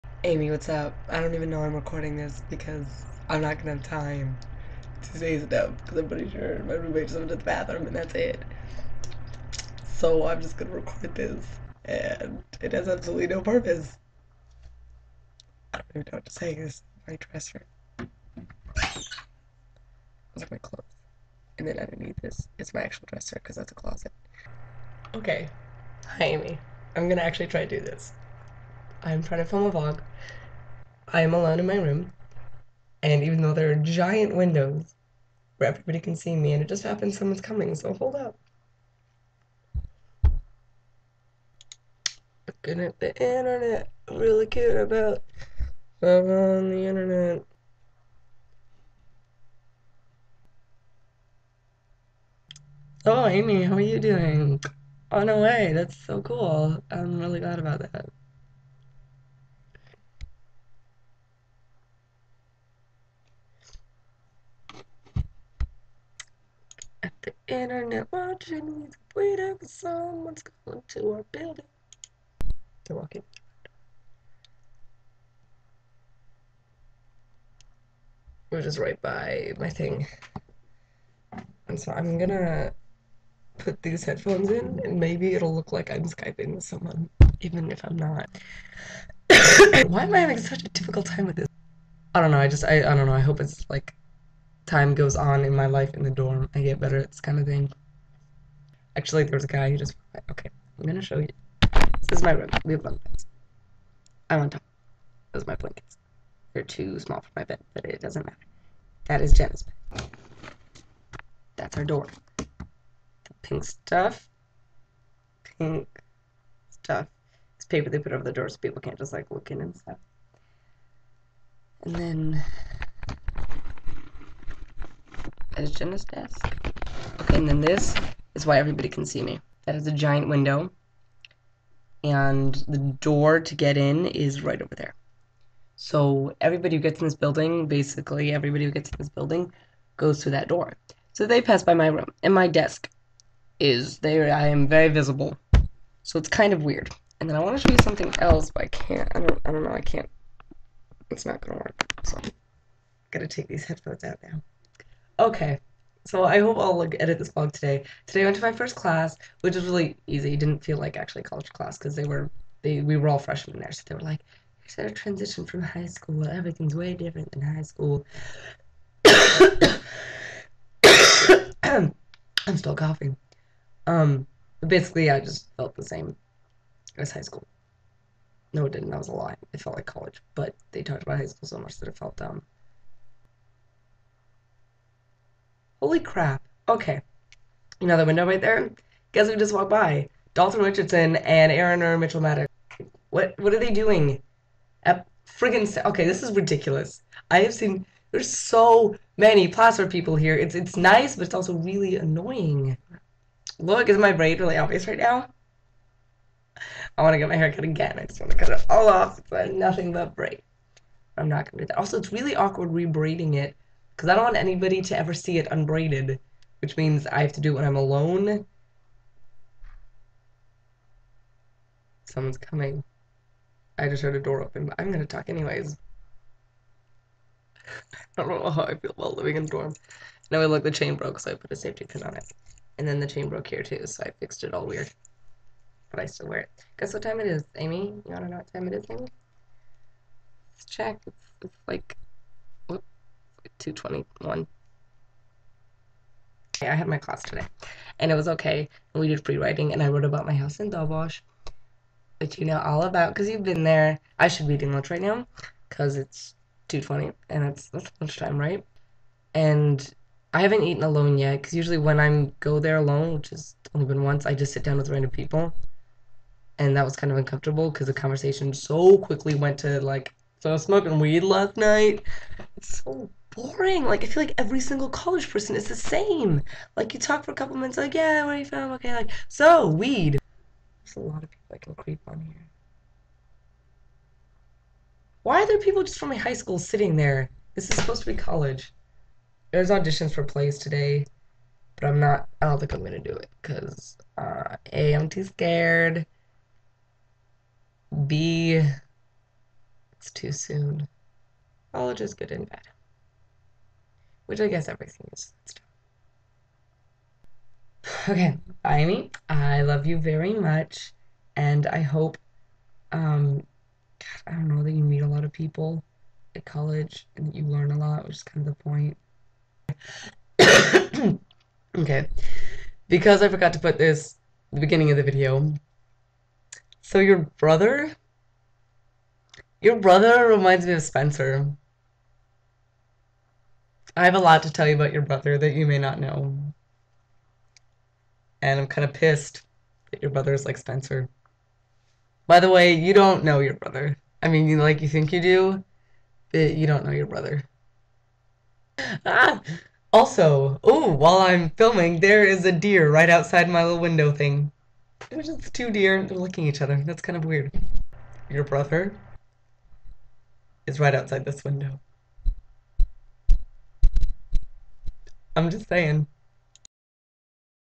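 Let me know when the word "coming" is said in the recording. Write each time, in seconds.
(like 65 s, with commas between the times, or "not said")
37 s, 222 s.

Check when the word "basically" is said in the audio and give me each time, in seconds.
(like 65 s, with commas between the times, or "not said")
137 s, 174 s.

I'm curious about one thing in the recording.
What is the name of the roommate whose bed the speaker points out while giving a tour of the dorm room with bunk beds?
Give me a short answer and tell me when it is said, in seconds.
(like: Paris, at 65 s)
Jenna, at 109 s.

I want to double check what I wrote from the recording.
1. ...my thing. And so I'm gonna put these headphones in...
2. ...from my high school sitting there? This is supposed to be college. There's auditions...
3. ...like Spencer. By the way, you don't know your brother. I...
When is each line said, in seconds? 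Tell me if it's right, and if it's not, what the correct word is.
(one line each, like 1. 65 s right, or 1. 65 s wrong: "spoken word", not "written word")
1. 79 s right
2. 285 s right
3. 340 s right.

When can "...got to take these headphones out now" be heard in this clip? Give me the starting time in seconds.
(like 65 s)
153 s.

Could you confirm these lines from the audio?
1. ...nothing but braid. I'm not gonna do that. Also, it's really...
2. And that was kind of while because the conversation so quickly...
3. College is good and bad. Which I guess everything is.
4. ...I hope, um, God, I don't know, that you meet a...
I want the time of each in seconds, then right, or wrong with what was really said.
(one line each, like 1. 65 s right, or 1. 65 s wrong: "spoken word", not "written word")
1. 209 s right
2. 266 s wrong: "uncomfortable", not "while"
3. 301 s right
4. 311 s right.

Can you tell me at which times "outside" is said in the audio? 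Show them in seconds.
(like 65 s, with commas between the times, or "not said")
353 s, 360 s.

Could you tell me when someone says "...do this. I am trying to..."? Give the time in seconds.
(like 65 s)
27 s.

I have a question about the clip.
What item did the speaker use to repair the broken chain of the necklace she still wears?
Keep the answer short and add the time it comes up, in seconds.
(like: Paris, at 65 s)
Safety pin, at 231 s.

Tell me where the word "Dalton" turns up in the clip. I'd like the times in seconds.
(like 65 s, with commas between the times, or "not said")
190 s.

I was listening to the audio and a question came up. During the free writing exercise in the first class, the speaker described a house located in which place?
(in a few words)
Dobosh.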